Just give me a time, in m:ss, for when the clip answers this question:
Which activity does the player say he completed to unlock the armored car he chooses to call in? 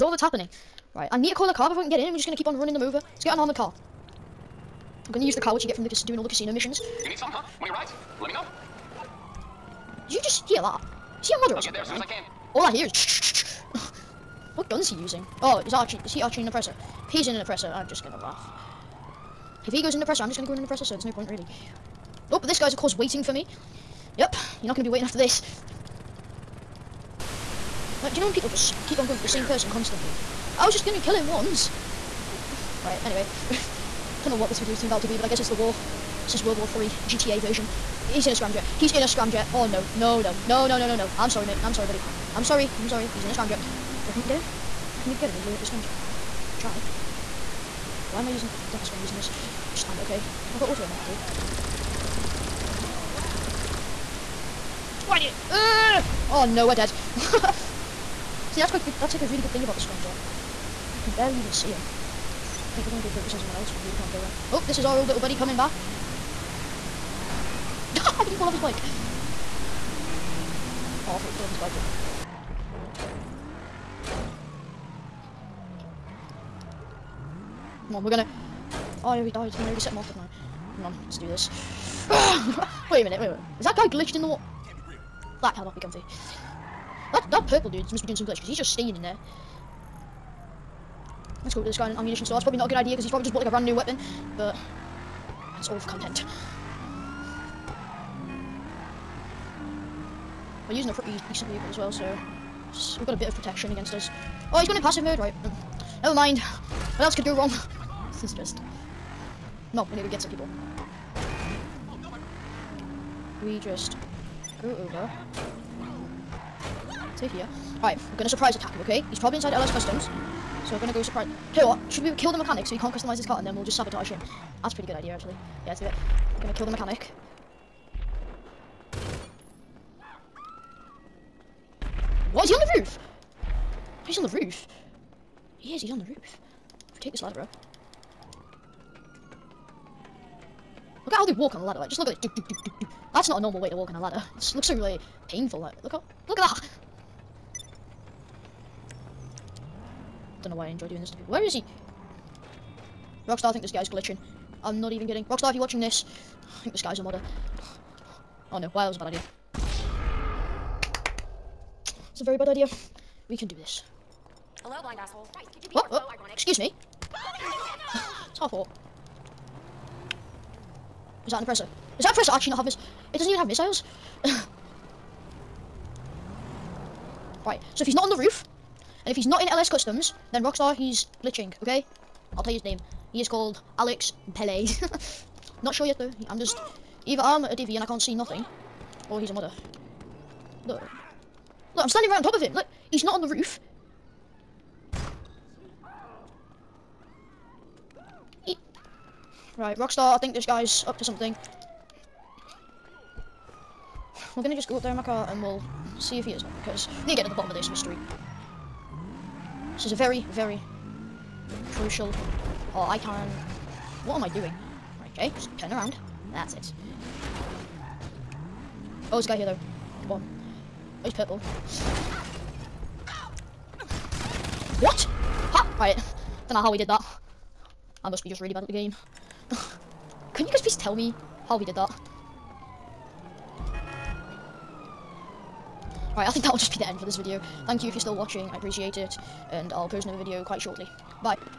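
0:06.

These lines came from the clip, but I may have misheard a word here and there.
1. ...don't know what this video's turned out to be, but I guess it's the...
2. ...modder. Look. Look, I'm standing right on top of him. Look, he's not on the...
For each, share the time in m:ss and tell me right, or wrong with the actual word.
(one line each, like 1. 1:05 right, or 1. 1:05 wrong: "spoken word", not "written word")
1. 0:34 right
2. 3:09 right.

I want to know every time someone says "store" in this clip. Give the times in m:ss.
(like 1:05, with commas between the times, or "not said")
1:32.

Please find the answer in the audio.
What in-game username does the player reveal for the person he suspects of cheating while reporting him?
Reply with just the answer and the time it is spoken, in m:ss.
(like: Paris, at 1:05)
Alex Pele, at 3:03.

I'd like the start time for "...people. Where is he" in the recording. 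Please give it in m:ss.
2:31.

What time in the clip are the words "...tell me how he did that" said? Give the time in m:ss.
3:50.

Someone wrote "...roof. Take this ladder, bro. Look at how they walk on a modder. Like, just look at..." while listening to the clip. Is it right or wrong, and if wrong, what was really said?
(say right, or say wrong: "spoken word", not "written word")
wrong: "ladder", not "modder".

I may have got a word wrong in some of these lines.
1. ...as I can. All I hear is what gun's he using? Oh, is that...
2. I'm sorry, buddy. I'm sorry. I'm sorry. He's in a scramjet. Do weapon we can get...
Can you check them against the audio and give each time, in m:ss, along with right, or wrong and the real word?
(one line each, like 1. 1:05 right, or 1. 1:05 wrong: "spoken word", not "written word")
1. 0:11 right
2. 0:41 wrong: "reckon", not "weapon".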